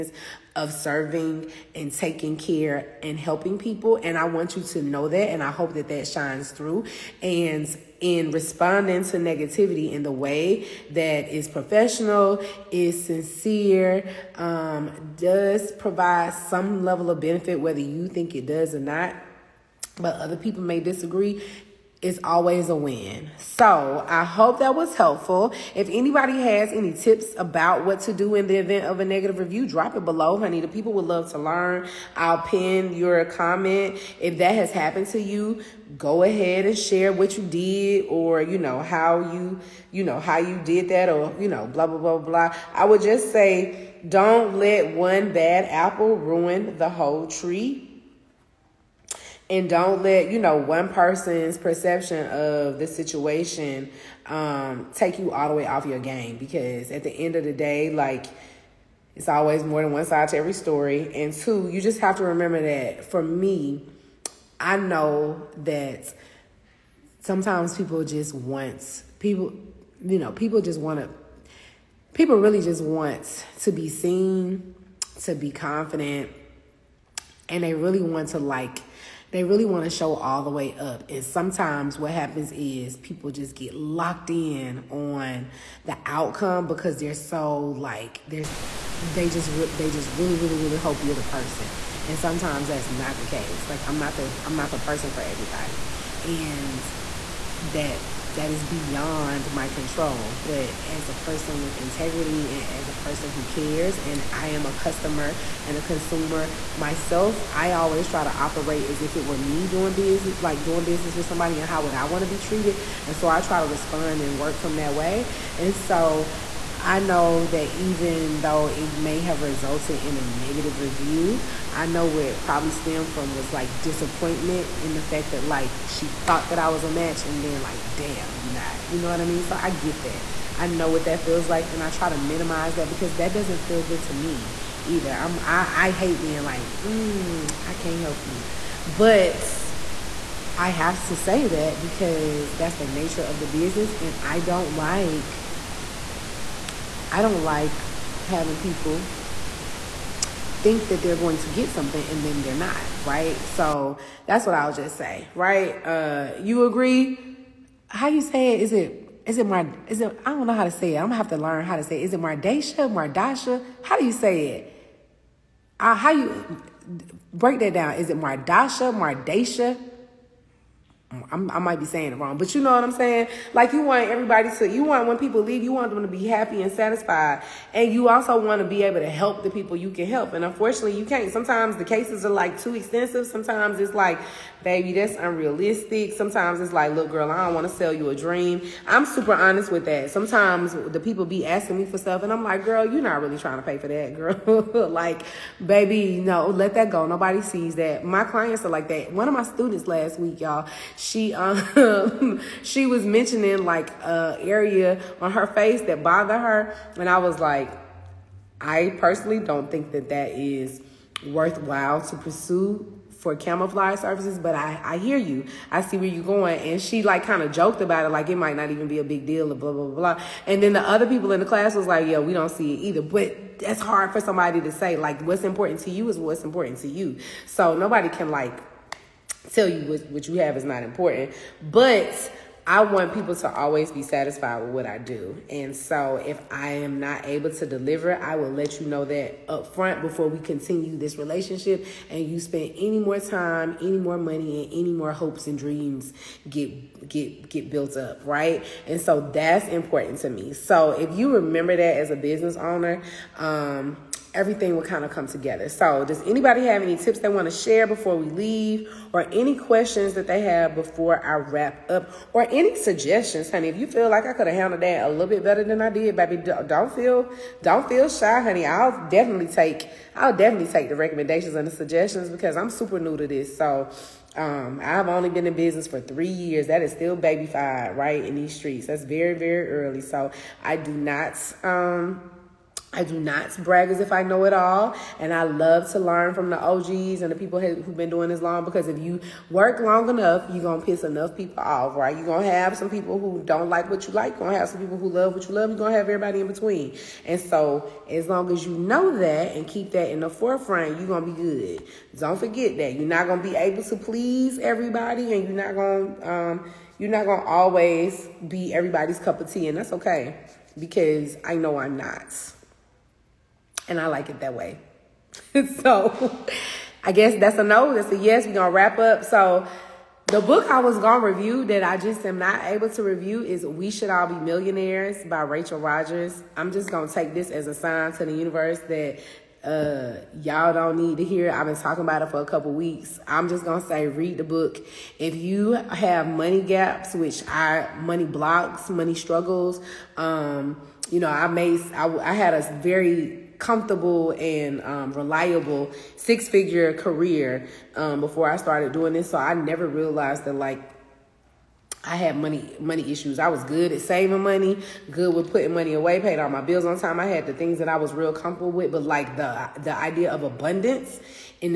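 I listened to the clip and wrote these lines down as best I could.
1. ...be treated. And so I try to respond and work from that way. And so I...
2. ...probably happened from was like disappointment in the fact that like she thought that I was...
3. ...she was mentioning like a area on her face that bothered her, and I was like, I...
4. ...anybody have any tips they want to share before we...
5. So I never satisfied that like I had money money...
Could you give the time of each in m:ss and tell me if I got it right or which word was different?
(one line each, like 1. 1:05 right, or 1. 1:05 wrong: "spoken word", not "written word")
1. 1:52 right
2. 2:02 wrong: "stemmed", not "happened"
3. 3:22 right
4. 4:16 right
5. 5:49 wrong: "realized", not "satisfied".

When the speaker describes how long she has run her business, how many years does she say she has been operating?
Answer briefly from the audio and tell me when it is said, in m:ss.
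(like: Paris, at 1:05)
3, at 4:36.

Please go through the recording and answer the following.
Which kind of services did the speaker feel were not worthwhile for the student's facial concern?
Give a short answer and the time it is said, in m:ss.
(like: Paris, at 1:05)
camouflage services, at 3:33.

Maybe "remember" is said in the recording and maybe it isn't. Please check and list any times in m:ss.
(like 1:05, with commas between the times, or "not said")
1:02, 4:11.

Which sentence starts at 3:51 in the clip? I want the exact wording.
But I want people to always be satisfied with what I do.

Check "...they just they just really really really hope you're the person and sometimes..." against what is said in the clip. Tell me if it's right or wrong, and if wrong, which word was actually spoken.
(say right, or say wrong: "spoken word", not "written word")
right.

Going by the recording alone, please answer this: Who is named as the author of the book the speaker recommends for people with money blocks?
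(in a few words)
Rachel Rodgers.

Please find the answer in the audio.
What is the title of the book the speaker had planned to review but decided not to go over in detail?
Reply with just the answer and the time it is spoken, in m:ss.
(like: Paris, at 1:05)
We Should All Be Millionaires, at 5:23.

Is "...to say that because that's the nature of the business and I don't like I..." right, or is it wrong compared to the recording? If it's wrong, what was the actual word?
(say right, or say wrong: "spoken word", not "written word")
right.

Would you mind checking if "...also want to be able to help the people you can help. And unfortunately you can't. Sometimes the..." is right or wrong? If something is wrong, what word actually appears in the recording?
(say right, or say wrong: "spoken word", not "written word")
right.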